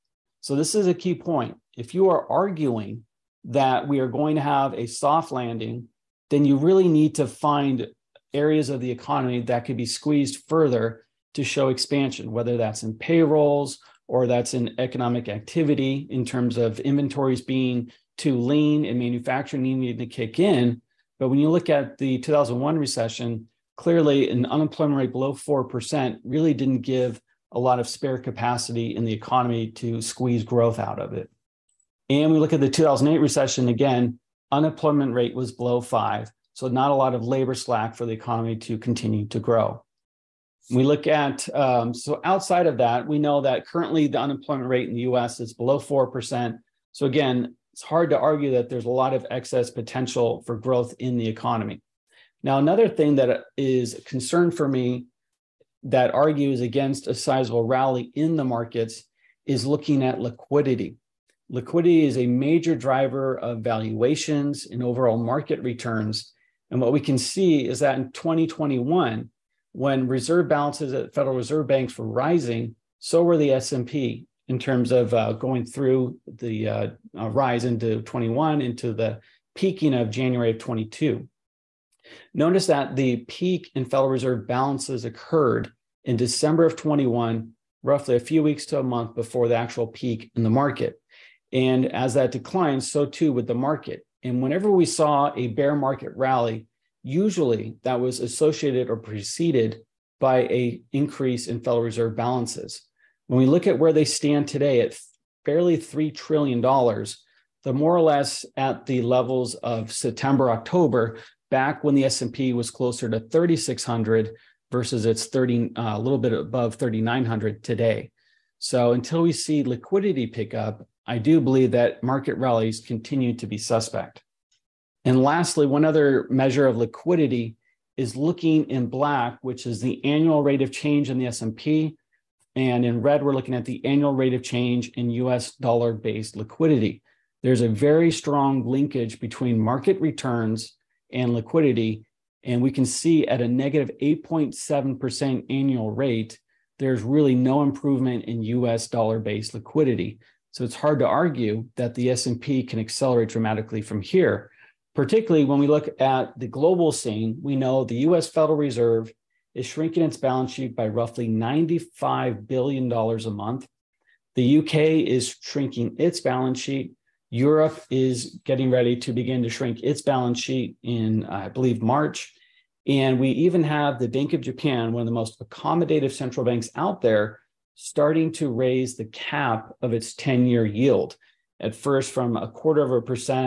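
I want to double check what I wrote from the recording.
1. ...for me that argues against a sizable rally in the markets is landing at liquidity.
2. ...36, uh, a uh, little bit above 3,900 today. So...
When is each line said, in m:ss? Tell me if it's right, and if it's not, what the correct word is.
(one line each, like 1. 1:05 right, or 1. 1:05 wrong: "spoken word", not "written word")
1. 0:54 wrong: "looking", not "landing"
2. 1:55 wrong: "30", not "36".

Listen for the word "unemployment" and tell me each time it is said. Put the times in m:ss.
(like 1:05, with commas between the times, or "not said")
0:24, 0:34, 0:44.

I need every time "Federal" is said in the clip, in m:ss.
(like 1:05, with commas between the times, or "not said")
1:11, 1:23, 1:41, 2:38.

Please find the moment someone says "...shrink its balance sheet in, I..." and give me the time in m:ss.
2:49.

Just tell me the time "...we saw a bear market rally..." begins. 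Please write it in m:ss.
1:34.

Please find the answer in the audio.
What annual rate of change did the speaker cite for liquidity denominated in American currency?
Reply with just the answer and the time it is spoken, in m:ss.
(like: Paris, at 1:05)
-8.7%, at 2:23.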